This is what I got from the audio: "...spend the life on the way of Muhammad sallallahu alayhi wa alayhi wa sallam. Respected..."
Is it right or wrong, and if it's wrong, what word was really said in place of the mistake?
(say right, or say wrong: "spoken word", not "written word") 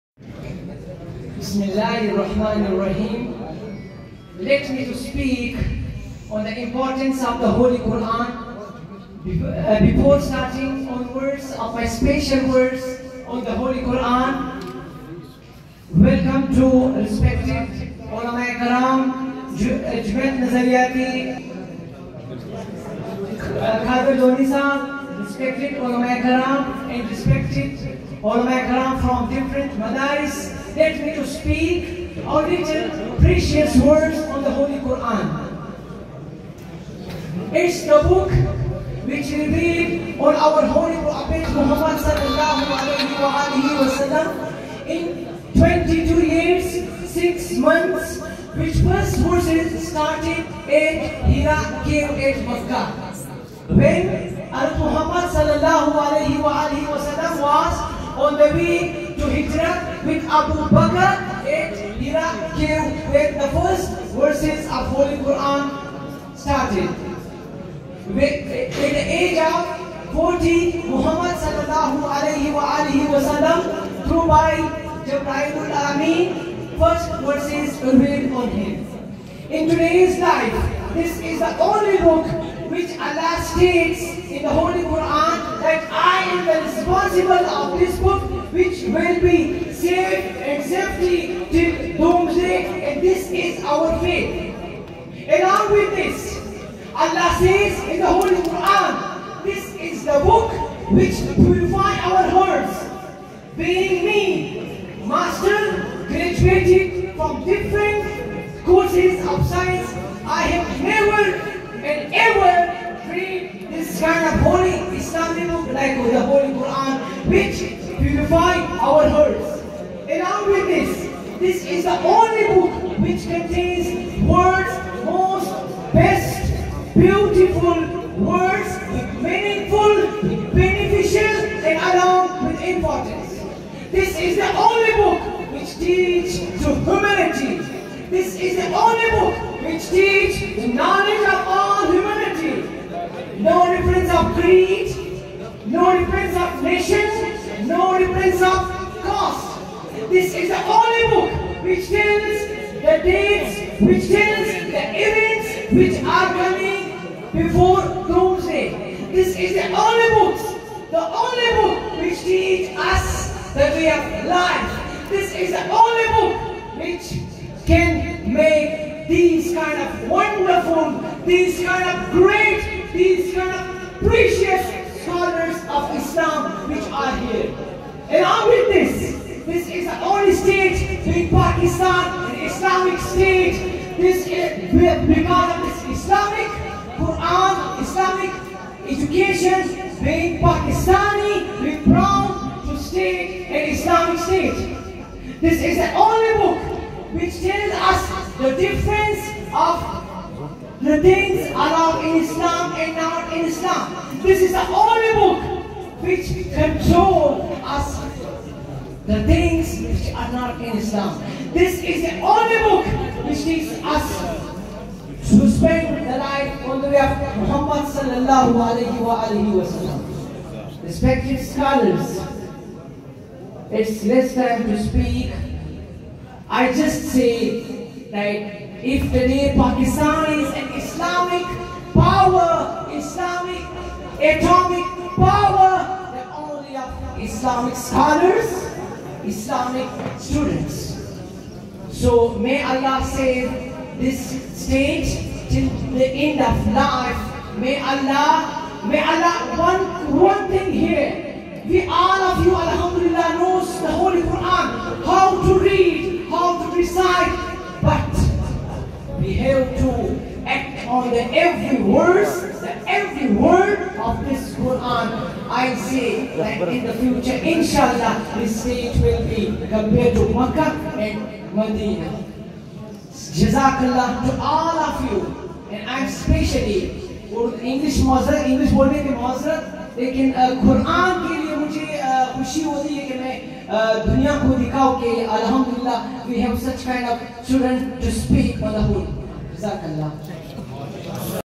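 right.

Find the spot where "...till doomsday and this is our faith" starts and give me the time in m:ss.
1:31.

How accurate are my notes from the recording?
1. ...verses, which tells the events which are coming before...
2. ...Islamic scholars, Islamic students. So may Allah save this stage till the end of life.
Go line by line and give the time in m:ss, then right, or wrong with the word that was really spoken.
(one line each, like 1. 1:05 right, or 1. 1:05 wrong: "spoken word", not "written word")
1. 2:33 wrong: "dates", not "verses"
2. 3:57 right.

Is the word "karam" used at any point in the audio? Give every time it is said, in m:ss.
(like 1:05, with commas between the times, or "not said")
0:18, 0:26.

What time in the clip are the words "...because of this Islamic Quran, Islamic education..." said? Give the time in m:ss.
3:04.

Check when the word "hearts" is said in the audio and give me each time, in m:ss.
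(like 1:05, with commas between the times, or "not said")
1:42, 1:59.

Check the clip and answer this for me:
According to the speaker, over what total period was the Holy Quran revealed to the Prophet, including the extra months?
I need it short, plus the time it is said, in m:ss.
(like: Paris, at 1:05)
22 years, 6 months, at 0:45.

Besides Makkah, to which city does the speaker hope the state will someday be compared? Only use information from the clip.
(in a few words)
Medina.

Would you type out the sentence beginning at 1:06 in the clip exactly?
At the age of 40, Muhammad sallallahu alayhi wa alihi wa sallam through by Jabrailul Ameen, first verses revealed on him.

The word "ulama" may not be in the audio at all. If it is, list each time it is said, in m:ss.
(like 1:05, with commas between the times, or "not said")
0:18, 0:25.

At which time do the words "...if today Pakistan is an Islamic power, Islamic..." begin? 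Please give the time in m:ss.
3:48.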